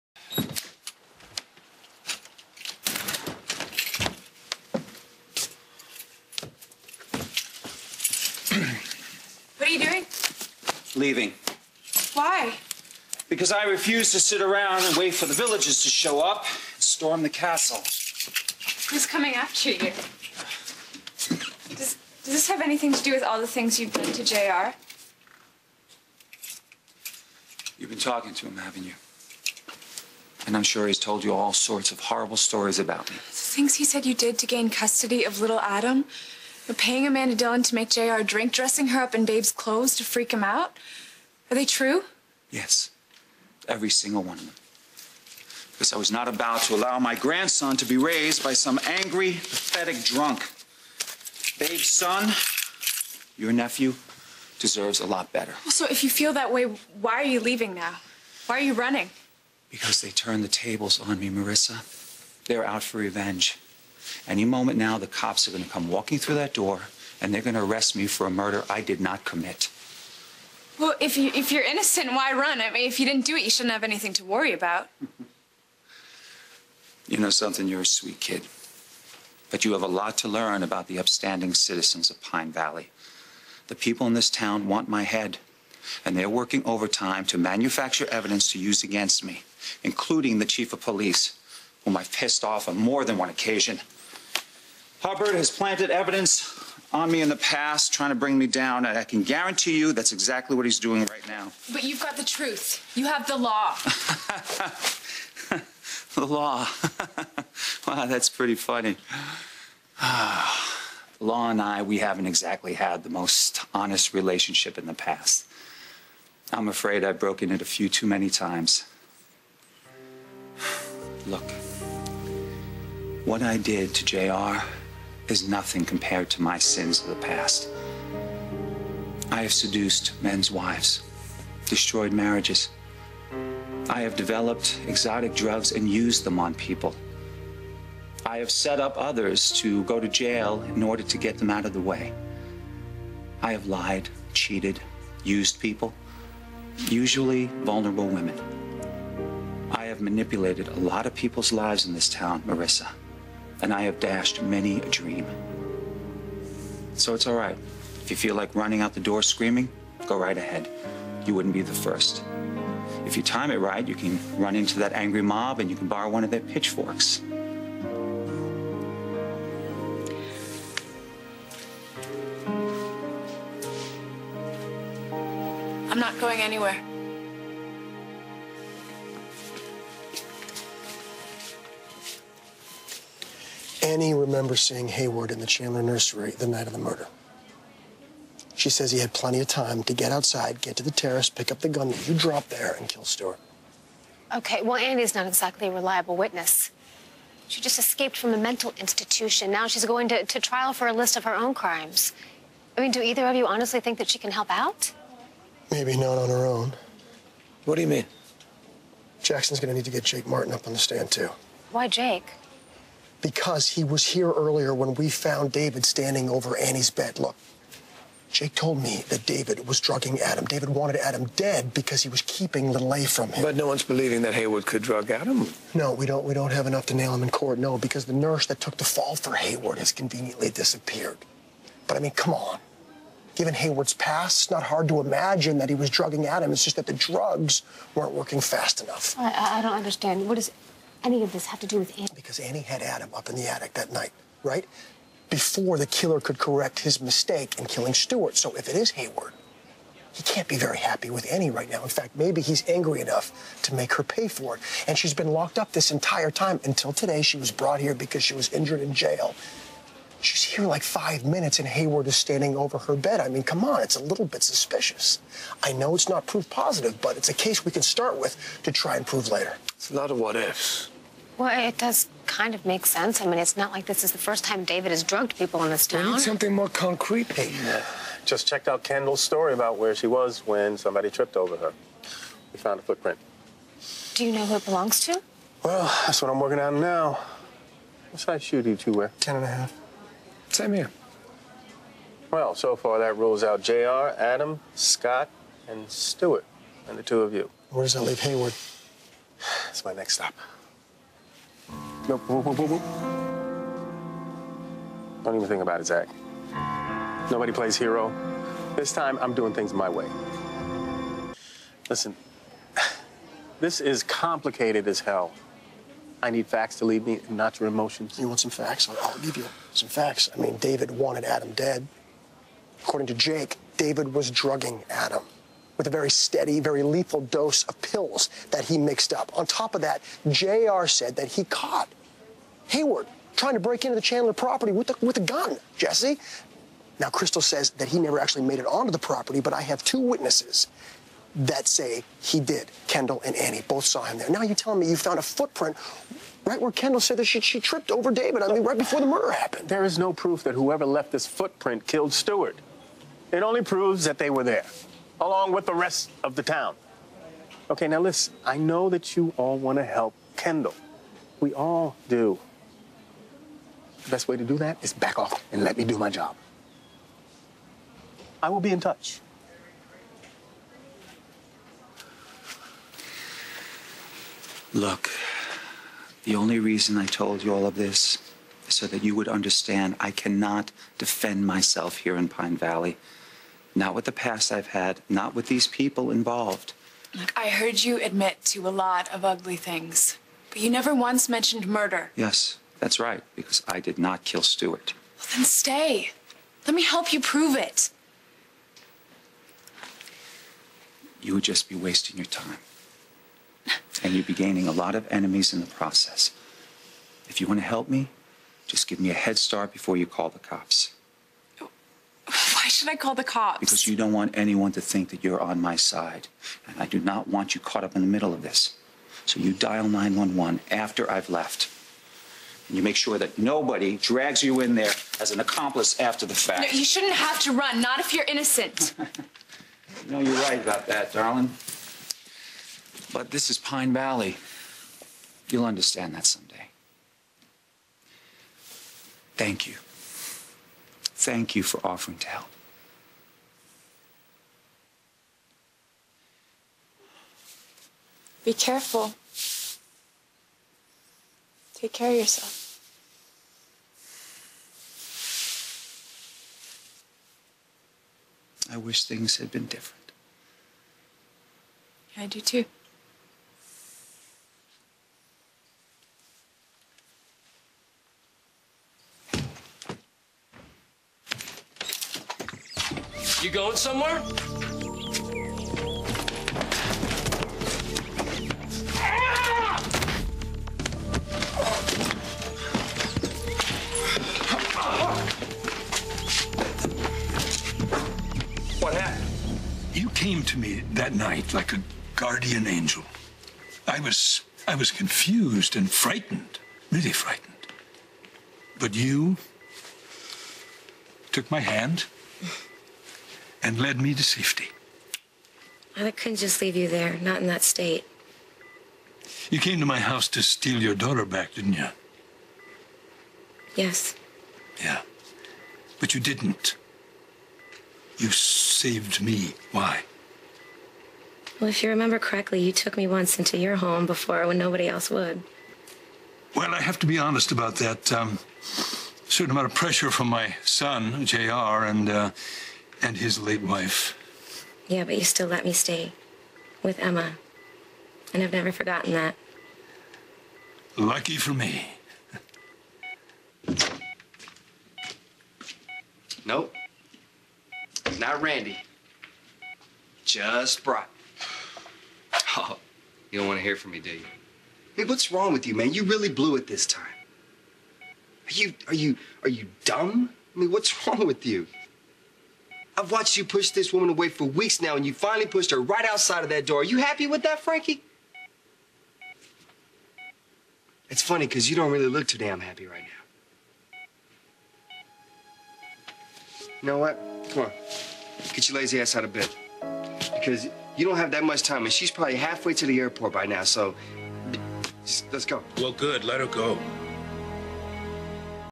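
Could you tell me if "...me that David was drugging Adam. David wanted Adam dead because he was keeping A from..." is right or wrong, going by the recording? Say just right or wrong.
right.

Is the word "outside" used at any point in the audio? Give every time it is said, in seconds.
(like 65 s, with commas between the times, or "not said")
190 s, 566 s.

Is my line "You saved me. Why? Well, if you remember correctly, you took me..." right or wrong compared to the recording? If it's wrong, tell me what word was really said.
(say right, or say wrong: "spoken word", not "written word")
right.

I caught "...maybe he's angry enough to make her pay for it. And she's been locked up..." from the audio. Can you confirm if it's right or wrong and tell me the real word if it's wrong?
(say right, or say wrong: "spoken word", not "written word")
right.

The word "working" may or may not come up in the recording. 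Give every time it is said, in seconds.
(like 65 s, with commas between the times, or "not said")
86 s, 238 s, 286 s.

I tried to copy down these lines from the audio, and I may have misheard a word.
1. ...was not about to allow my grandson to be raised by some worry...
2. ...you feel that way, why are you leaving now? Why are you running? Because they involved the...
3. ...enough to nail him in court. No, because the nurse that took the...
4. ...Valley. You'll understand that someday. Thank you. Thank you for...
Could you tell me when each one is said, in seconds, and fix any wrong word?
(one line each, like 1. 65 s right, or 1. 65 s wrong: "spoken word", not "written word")
1. 45 s wrong: "angry", not "worry"
2. 56 s wrong: "turned", not "involved"
3. 226 s right
4. 433 s right.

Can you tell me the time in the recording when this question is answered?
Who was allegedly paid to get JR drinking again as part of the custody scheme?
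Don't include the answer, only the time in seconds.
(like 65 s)
37 s.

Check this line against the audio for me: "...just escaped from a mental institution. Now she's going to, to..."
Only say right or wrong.
right.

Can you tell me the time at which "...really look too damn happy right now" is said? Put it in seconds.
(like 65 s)
571 s.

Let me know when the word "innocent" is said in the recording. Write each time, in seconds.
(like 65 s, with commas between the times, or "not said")
71 s, 428 s.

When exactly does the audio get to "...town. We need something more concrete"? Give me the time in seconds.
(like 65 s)
275 s.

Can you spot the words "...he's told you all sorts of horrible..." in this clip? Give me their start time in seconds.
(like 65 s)
30 s.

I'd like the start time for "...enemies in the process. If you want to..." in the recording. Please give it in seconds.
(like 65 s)
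405 s.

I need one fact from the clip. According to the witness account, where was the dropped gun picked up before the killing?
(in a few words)
the terrace.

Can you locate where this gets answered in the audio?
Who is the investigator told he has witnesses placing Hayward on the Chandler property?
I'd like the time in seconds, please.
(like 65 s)
335 s.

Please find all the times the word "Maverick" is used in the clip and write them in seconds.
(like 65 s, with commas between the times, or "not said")
not said.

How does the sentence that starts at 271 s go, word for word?
Well, it does kind of make sense.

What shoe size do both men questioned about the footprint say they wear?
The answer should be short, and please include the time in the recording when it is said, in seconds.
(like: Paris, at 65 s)
10.5, at 289 s.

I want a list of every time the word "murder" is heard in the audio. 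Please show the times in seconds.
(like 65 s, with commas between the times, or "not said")
68 s, 186 s, 349 s, 391 s.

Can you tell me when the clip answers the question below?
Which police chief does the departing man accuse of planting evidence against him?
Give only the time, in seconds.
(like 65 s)
95 s.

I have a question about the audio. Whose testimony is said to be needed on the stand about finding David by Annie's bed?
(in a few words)
Jake Martin.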